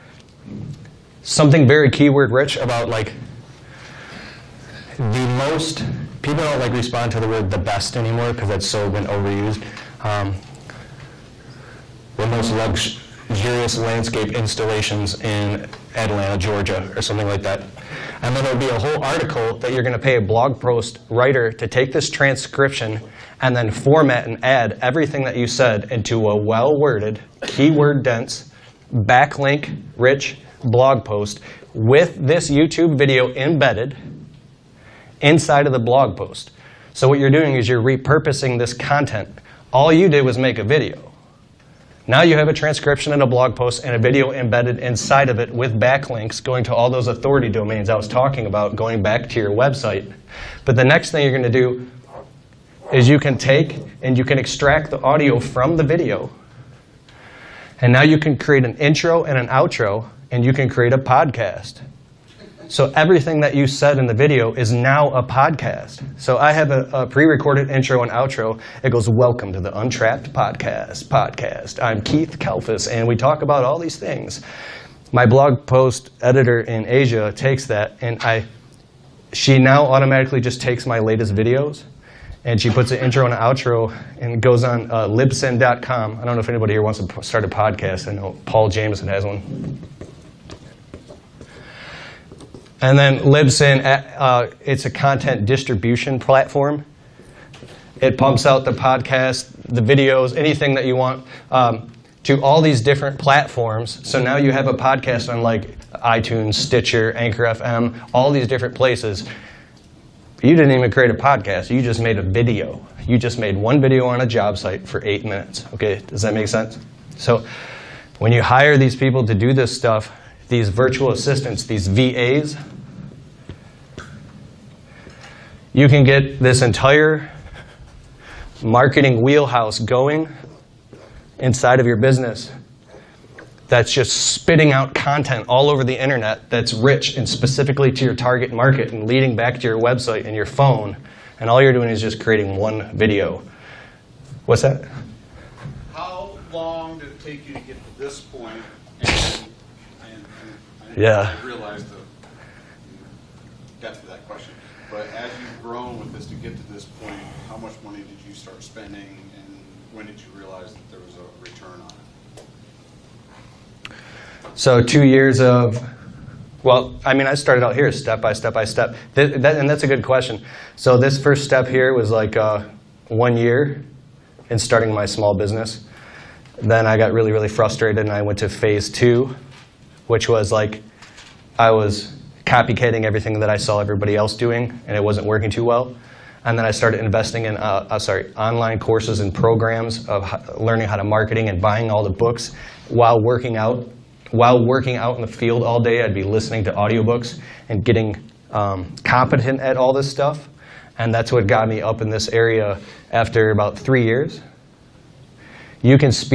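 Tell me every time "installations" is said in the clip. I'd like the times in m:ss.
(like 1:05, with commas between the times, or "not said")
0:14.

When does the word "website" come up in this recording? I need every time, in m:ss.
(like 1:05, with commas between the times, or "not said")
0:49, 2:19.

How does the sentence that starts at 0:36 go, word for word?
So what you're doing is you're repurposing this content.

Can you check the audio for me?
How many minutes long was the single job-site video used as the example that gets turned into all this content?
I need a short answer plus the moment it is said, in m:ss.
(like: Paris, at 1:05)
8, at 1:55.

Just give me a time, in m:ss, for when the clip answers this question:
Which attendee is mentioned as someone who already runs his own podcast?
1:28.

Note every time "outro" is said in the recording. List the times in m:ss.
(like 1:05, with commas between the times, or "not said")
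0:59, 1:08, 1:23.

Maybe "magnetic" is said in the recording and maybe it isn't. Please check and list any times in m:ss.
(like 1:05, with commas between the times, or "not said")
not said.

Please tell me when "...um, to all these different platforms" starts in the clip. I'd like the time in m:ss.
1:41.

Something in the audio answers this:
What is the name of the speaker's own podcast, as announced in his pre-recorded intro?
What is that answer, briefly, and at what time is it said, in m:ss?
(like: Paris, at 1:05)
Untrapped Podcast, at 1:09.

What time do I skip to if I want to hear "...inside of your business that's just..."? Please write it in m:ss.
2:11.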